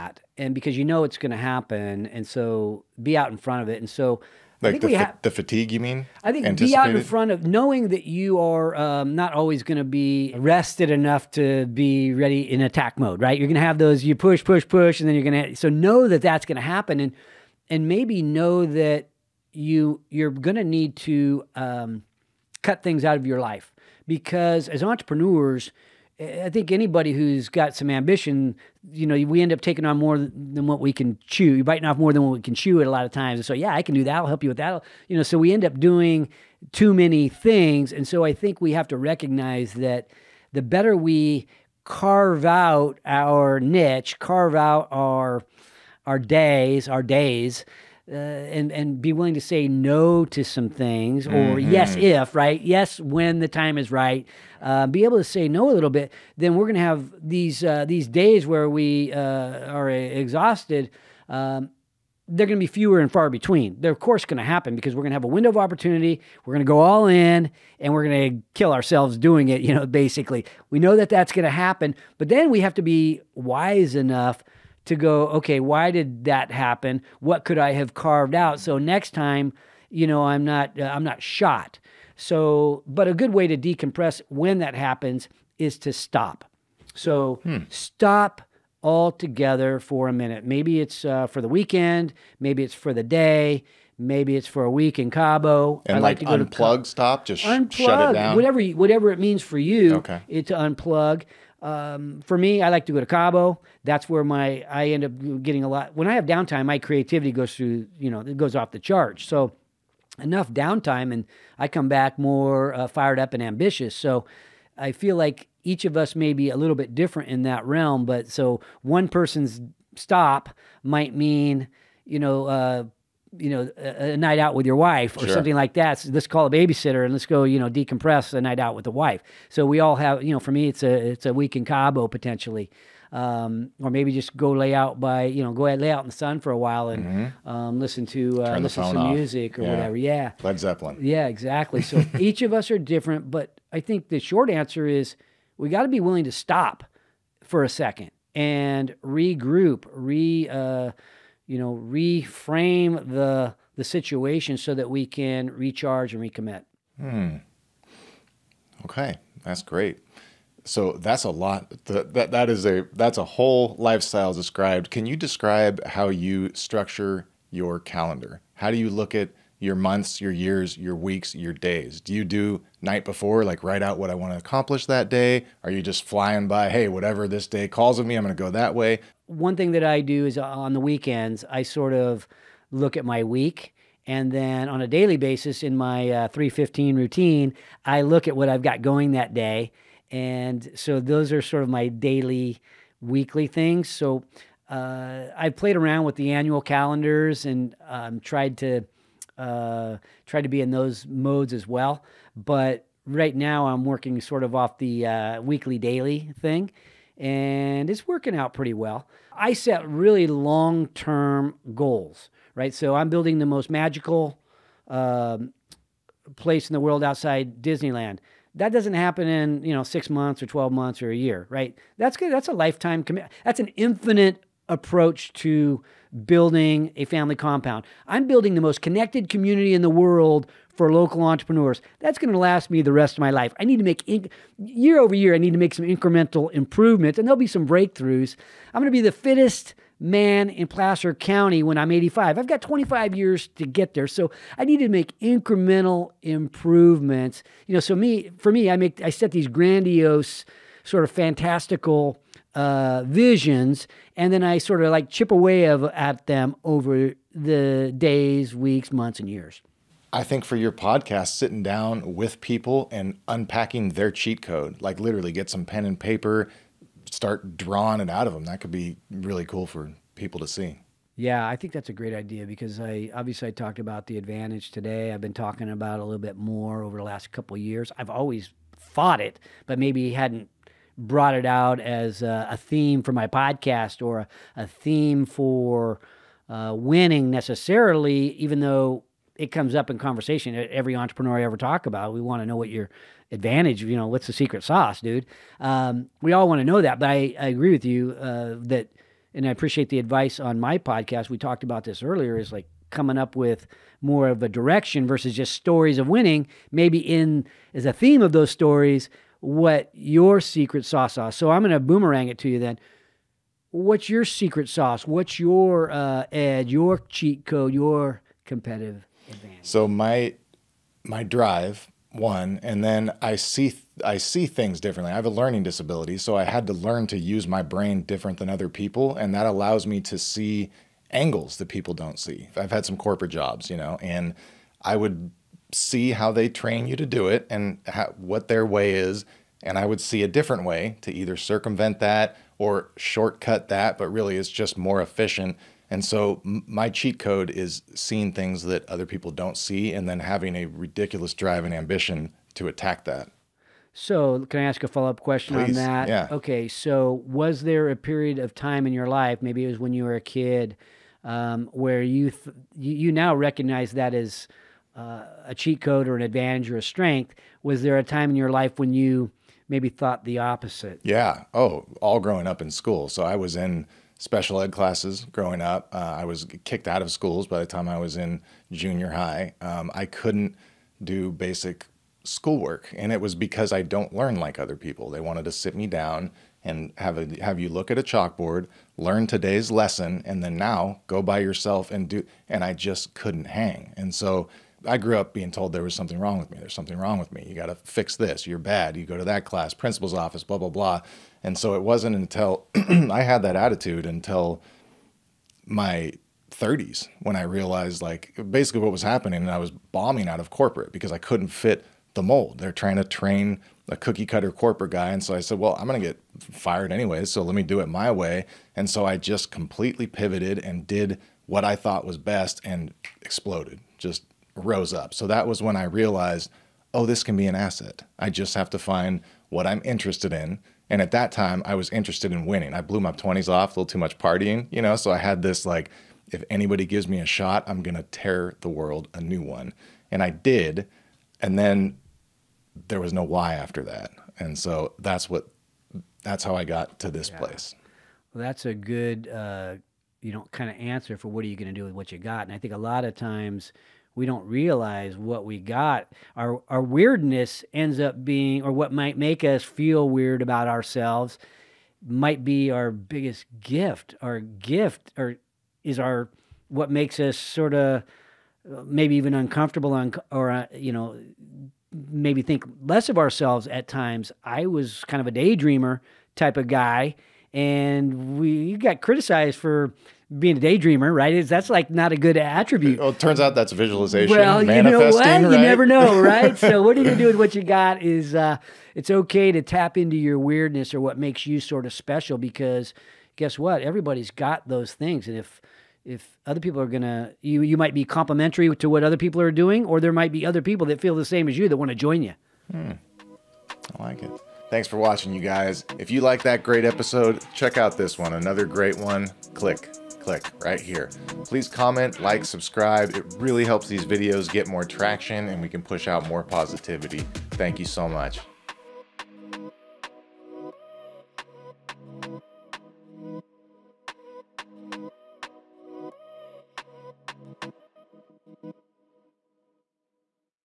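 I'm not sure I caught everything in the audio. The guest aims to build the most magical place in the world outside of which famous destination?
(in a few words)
Disneyland.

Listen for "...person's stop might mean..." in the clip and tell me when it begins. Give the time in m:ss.
1:59.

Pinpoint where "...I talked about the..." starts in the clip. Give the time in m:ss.
4:33.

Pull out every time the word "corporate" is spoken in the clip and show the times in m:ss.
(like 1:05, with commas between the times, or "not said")
5:32, 6:50, 6:54.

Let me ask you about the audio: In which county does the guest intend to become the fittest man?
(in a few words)
Placer County.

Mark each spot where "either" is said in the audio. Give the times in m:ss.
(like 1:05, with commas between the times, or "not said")
5:41.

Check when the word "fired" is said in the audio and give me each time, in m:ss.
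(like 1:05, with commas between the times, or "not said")
1:52, 6:56.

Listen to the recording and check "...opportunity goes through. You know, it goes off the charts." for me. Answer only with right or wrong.
wrong.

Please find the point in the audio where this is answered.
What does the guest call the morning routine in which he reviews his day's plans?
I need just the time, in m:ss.
3:06.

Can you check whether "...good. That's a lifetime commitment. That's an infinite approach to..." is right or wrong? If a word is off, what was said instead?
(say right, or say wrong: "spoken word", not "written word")
right.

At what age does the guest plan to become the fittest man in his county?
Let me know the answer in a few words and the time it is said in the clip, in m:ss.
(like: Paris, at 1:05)
85, at 4:01.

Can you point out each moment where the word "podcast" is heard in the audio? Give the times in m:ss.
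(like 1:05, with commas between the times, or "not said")
4:20, 4:43, 5:00.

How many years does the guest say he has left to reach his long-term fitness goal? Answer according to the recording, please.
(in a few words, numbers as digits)
25.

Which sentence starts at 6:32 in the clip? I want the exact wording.
And I just couldn't hang, and so I grew up being told there was something wrong with me.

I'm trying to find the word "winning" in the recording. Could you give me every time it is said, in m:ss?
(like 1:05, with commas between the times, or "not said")
4:46, 5:06, 7:12.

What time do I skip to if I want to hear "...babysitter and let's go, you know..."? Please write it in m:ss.
2:06.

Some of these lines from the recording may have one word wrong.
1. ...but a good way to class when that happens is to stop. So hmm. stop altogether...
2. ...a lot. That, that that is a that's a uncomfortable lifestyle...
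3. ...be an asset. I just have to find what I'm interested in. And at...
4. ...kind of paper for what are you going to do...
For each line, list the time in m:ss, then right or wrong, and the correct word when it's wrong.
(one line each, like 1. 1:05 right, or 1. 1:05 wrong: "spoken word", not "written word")
1. 1:22 wrong: "decompress", not "class"
2. 2:41 wrong: "whole", not "uncomfortable"
3. 7:07 right
4. 7:30 wrong: "answer", not "paper".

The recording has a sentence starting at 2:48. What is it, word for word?
How do you look at your months, your years, your weeks, your days?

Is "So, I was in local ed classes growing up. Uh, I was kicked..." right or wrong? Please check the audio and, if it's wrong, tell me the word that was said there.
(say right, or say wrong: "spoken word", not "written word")
wrong: "special", not "local".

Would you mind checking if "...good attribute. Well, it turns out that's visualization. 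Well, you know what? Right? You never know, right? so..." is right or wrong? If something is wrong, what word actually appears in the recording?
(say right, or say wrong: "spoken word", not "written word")
right.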